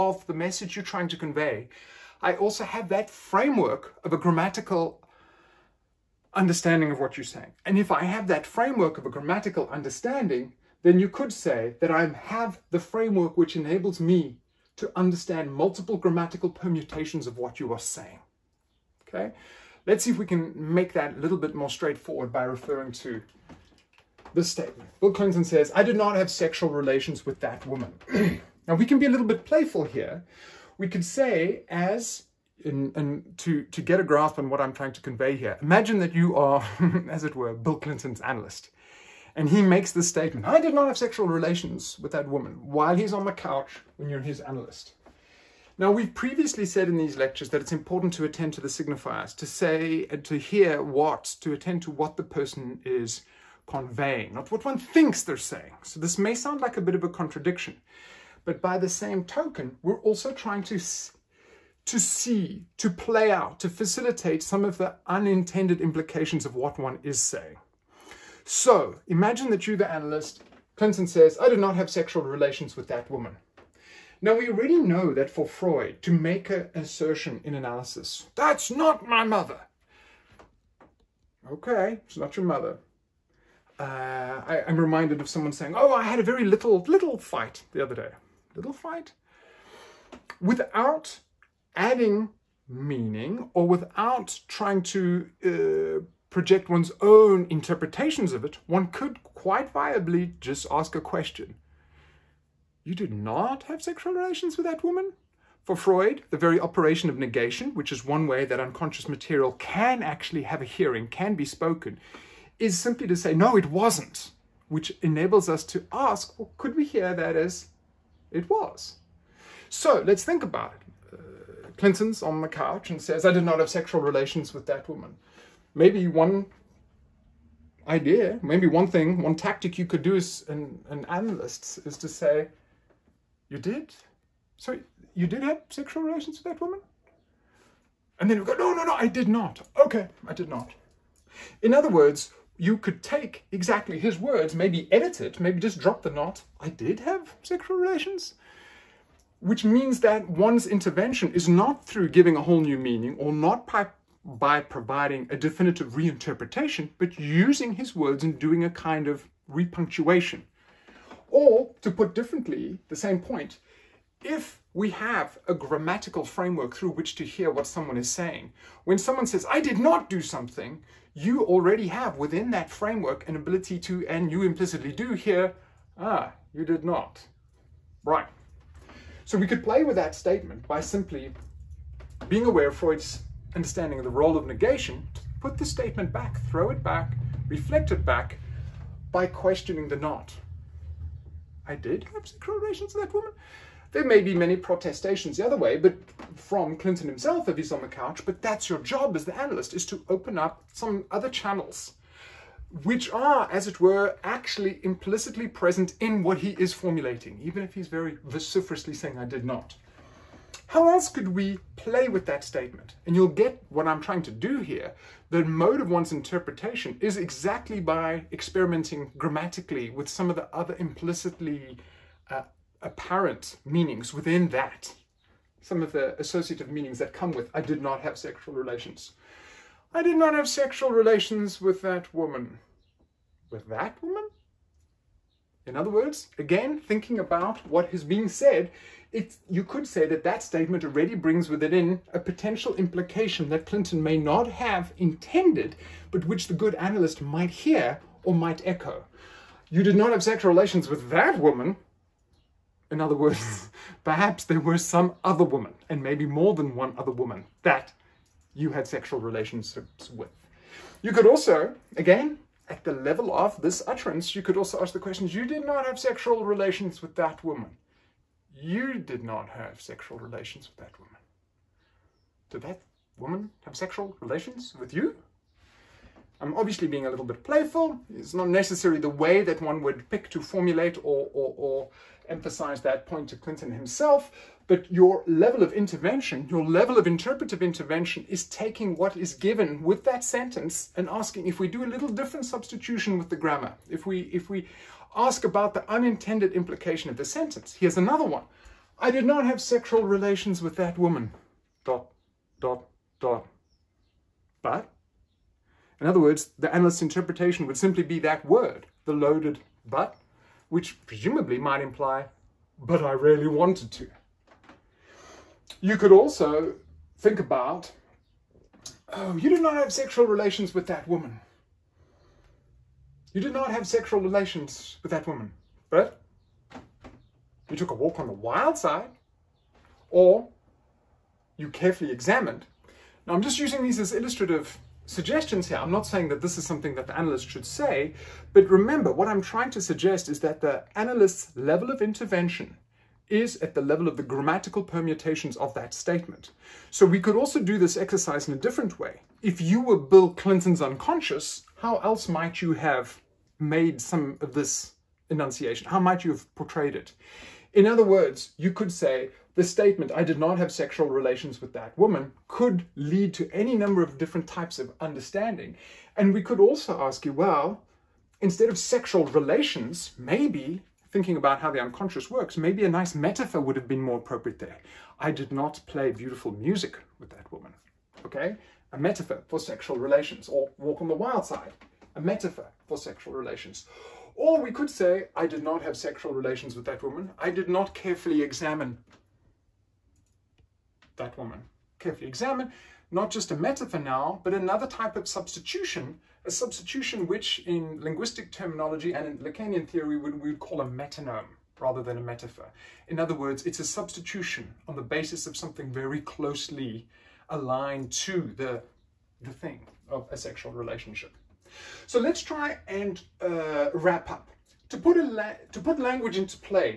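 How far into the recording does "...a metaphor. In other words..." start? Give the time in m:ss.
6:42.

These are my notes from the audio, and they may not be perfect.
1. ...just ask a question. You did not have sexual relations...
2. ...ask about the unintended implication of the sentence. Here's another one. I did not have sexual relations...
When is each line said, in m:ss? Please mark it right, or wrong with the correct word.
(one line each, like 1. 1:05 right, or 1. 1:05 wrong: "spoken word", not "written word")
1. 1:40 right
2. 4:55 right.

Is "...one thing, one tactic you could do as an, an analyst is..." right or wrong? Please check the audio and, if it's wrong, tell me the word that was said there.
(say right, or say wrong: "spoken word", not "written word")
right.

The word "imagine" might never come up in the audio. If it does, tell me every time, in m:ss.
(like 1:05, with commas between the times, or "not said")
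0:35, 1:09.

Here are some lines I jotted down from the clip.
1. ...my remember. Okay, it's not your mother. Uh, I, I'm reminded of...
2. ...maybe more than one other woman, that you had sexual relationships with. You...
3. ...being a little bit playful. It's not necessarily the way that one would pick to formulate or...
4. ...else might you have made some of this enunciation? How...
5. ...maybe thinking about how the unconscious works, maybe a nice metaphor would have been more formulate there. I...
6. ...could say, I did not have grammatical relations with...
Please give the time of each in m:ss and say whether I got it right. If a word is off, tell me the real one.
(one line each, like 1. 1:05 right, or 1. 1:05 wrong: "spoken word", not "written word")
1. 1:19 wrong: "mother", not "remember"
2. 4:16 right
3. 4:36 right
4. 5:51 right
5. 6:10 wrong: "appropriate", not "formulate"
6. 6:24 wrong: "sexual", not "grammatical".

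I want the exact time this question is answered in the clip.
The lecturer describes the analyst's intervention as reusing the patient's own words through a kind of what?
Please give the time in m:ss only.
2:39.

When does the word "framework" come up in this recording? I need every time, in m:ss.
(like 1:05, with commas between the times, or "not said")
0:03, 0:08, 0:12, 2:46, 2:52.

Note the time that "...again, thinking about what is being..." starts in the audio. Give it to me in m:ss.
3:56.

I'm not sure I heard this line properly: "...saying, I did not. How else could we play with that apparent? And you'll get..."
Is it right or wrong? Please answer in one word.
wrong.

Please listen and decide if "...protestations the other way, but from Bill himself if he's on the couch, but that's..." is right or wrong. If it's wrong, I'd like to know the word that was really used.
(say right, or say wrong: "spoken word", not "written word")
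wrong: "Clinton", not "Bill".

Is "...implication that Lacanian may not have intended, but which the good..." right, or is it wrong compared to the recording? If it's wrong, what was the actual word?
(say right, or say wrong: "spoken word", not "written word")
wrong: "Clinton", not "Lacanian".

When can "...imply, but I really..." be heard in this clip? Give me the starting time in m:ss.
5:11.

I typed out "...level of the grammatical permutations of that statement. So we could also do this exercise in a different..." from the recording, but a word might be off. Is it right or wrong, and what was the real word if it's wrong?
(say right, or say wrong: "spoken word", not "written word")
right.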